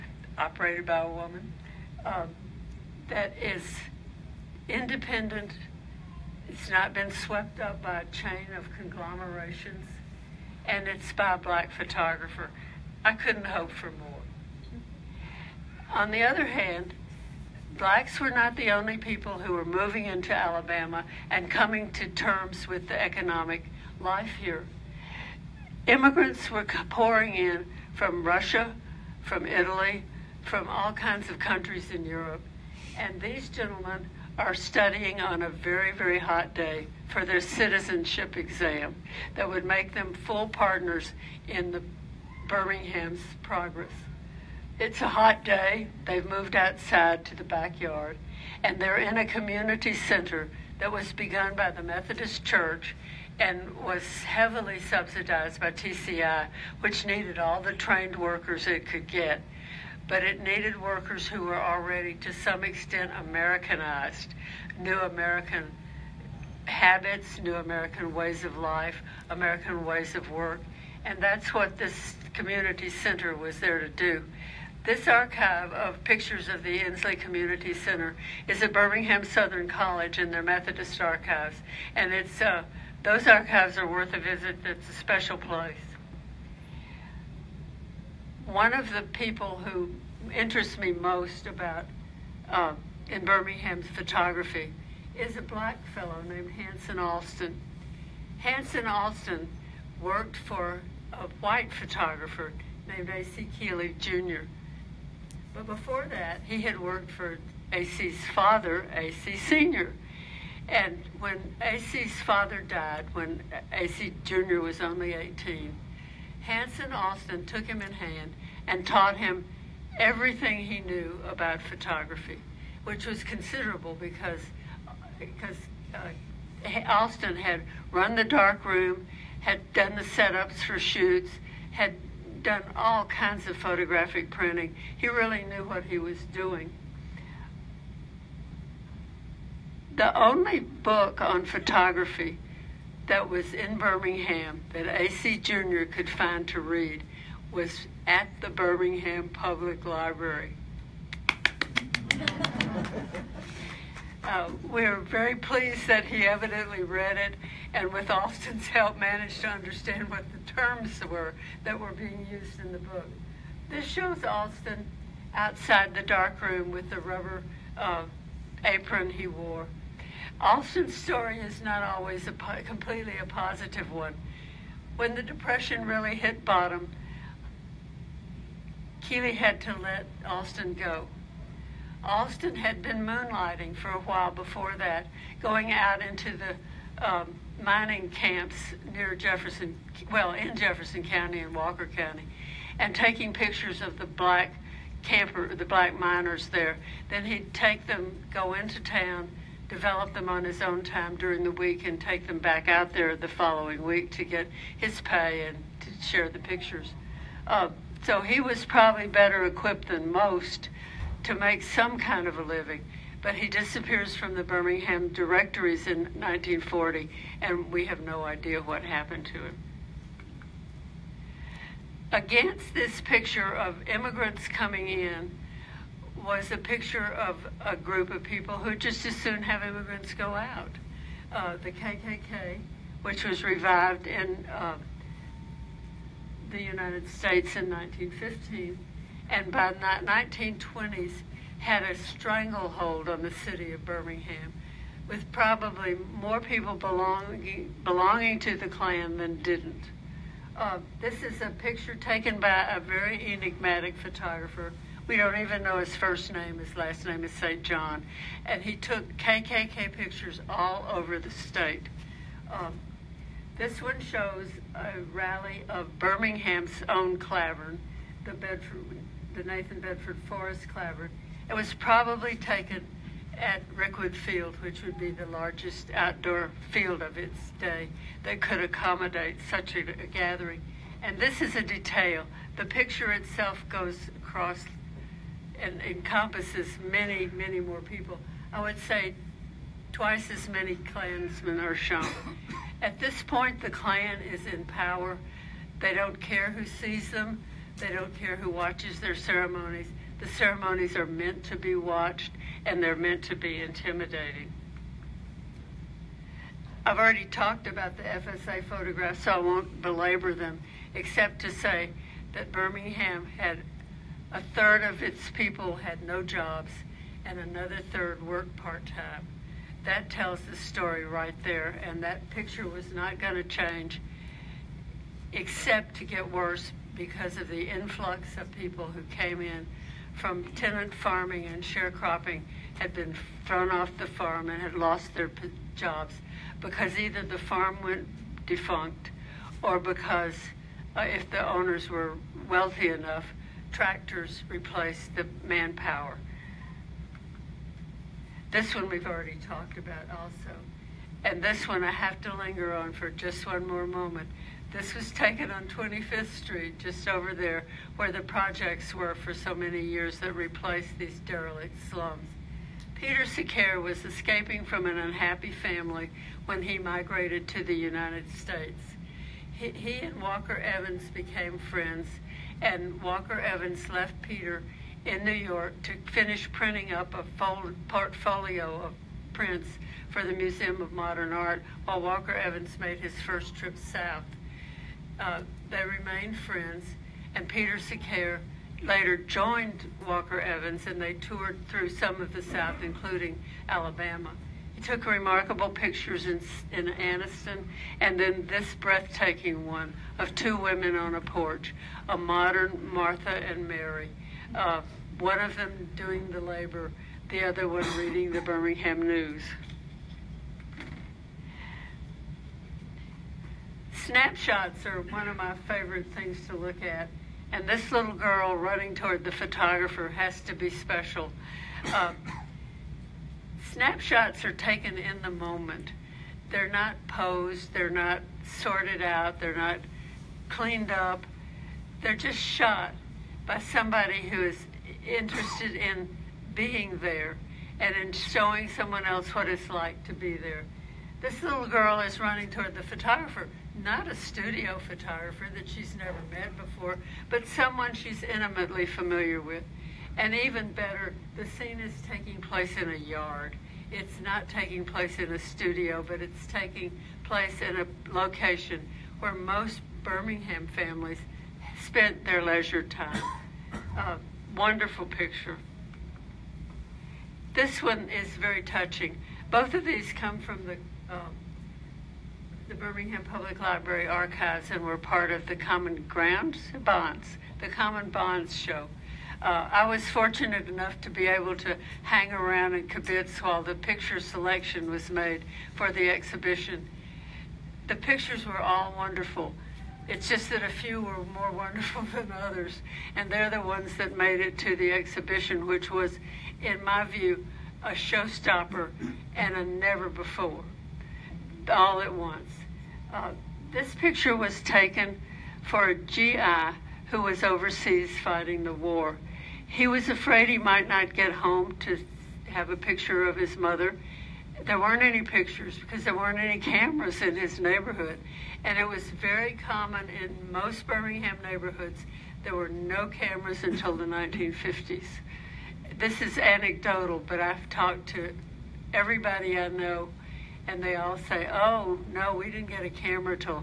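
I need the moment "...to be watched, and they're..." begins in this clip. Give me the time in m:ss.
5:01.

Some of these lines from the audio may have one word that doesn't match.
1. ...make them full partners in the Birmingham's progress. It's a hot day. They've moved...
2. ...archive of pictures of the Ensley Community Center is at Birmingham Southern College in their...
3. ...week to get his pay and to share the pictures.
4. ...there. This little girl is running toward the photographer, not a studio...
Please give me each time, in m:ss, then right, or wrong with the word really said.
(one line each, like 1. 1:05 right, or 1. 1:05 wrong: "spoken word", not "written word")
1. 0:39 right
2. 1:15 right
3. 3:23 right
4. 7:20 right.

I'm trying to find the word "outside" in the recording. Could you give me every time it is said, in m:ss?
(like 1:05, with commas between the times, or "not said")
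0:46, 2:45.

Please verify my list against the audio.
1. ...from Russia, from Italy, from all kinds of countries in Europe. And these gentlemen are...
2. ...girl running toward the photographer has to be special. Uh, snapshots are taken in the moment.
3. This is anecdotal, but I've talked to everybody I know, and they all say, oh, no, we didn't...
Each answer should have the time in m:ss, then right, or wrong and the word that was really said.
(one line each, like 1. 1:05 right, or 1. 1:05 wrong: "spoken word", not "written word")
1. 0:27 right
2. 6:58 right
3. 8:45 right.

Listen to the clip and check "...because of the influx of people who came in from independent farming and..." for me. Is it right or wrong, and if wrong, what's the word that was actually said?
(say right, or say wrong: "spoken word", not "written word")
wrong: "tenant", not "independent".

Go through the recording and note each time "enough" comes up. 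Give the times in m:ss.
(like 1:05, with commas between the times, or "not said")
5:42, 8:00.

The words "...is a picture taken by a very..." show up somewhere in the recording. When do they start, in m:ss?
4:11.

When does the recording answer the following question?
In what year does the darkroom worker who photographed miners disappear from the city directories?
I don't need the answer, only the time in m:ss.
3:36.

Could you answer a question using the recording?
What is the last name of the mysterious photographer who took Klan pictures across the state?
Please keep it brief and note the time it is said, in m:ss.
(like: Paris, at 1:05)
St. John, at 4:17.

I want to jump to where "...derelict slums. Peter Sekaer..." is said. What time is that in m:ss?
6:01.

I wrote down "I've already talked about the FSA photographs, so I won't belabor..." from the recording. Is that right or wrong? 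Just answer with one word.
right.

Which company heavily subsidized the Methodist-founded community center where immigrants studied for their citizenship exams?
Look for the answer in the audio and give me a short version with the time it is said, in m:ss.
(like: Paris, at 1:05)
TCI, at 0:55.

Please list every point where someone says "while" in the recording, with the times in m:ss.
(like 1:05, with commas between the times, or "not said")
3:04, 6:21, 8:03.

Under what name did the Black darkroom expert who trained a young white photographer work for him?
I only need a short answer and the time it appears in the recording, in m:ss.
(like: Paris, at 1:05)
A.C. Keeley Jr., at 1:43.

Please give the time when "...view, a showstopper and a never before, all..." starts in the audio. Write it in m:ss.
8:17.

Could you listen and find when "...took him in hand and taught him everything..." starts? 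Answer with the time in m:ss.
1:57.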